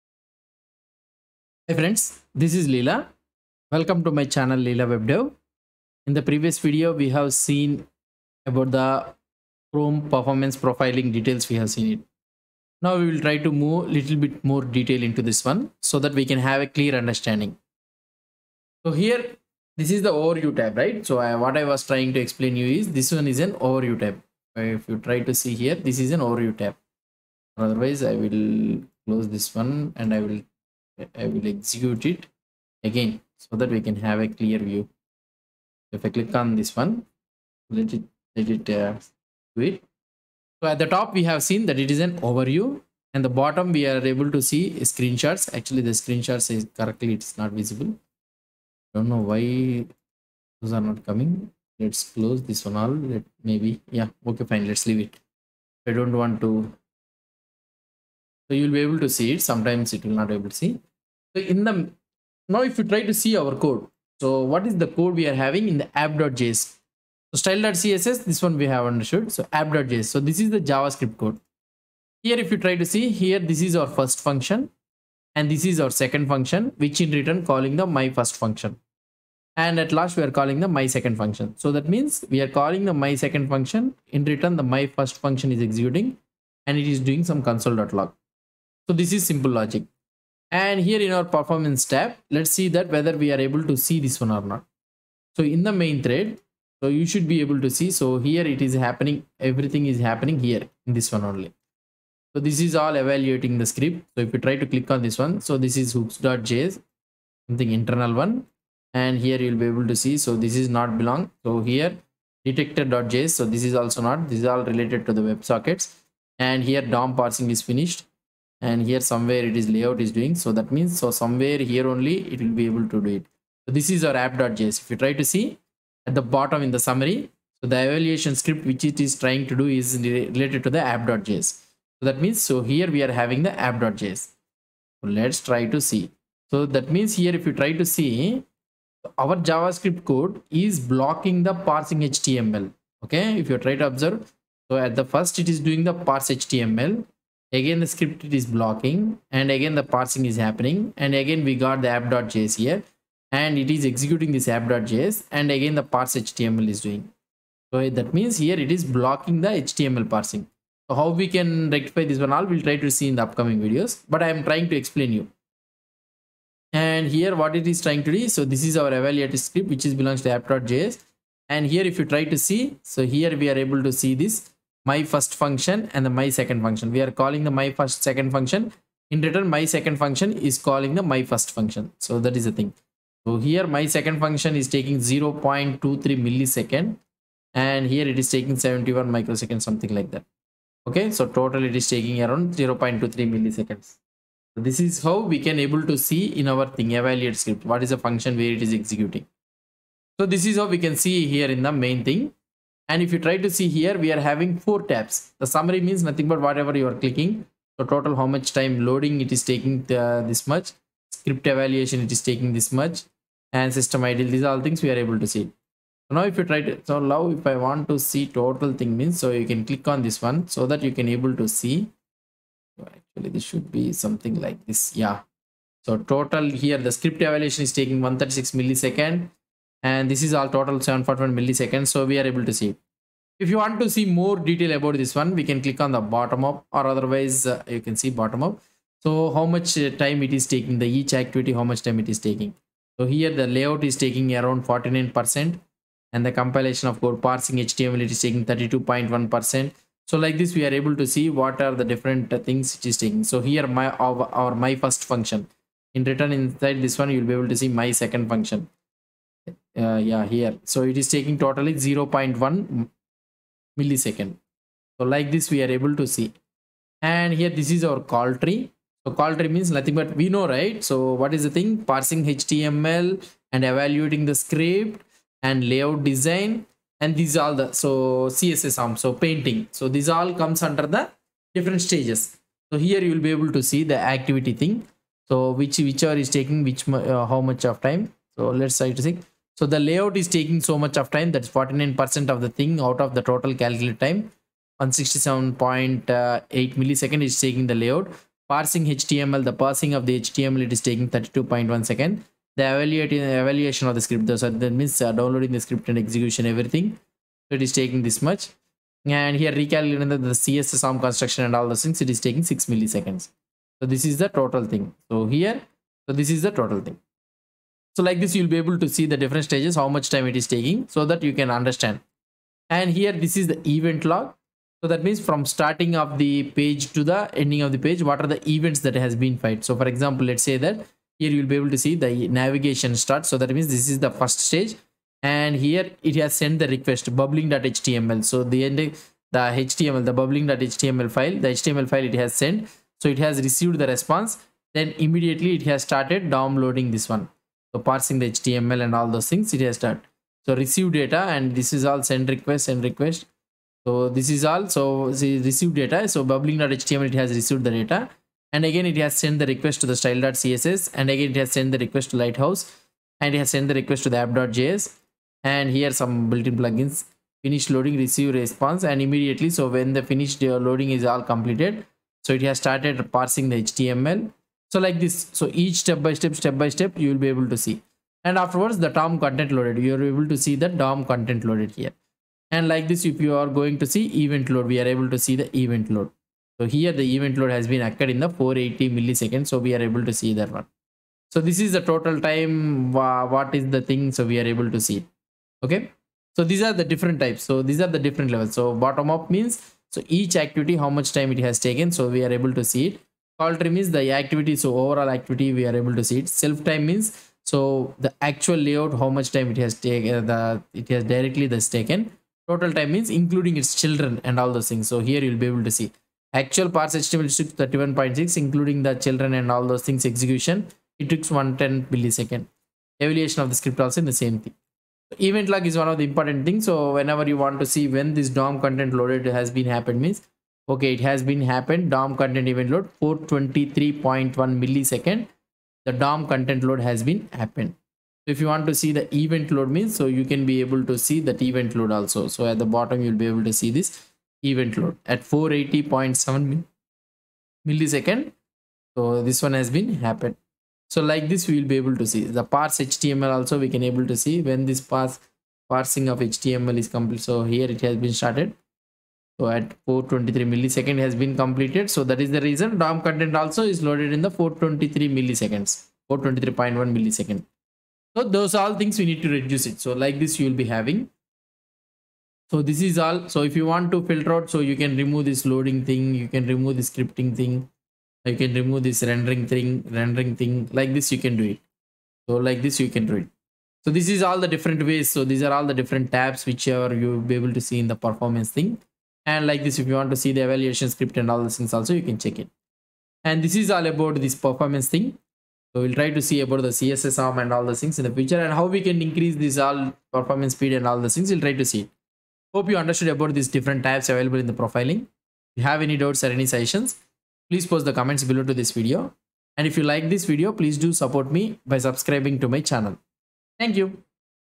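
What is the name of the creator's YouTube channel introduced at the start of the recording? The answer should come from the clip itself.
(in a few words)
Leela WebDev.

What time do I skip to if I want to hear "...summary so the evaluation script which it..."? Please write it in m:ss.
2:06.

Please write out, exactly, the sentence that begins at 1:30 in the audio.
And here in our performance tab, let's see that whether we are able to see this one or not.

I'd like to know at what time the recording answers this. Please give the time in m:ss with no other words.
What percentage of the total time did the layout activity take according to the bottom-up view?
4:04.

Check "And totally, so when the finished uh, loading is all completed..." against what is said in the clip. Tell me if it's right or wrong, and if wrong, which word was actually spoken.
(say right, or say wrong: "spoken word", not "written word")
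wrong: "immediately", not "totally".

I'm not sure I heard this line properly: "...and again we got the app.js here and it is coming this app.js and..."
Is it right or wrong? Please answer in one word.
wrong.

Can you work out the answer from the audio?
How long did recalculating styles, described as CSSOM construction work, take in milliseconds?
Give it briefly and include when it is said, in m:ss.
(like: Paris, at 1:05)
6 milliseconds, at 5:12.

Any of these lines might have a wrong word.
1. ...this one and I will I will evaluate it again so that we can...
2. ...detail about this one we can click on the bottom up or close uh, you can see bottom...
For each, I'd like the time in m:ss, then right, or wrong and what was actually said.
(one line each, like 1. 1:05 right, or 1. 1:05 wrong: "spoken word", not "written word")
1. 0:29 wrong: "execute", not "evaluate"
2. 3:54 wrong: "otherwise", not "close".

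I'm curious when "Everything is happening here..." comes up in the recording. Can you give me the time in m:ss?
1:39.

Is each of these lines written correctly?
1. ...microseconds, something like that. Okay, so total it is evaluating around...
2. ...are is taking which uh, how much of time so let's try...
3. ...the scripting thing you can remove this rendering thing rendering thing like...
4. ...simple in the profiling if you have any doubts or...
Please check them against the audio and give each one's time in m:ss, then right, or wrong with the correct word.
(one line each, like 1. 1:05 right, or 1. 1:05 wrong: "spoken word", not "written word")
1. 3:09 wrong: "taking", not "evaluating"
2. 4:46 right
3. 7:56 right
4. 8:24 wrong: "available", not "simple".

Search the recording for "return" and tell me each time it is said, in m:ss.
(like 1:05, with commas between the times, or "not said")
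1:17, 1:24, 2:59, 4:16.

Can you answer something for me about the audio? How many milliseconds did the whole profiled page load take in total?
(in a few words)
741 milliseconds.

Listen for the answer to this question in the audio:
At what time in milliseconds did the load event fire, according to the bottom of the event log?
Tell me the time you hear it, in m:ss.
7:25.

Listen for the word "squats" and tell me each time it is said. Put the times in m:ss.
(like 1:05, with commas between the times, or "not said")
not said.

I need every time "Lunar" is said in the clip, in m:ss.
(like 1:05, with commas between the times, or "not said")
not said.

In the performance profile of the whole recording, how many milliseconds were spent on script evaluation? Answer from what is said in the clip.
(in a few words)
136 milliseconds.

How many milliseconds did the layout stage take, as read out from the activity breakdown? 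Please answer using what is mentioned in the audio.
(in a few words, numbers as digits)
167.8 milliseconds.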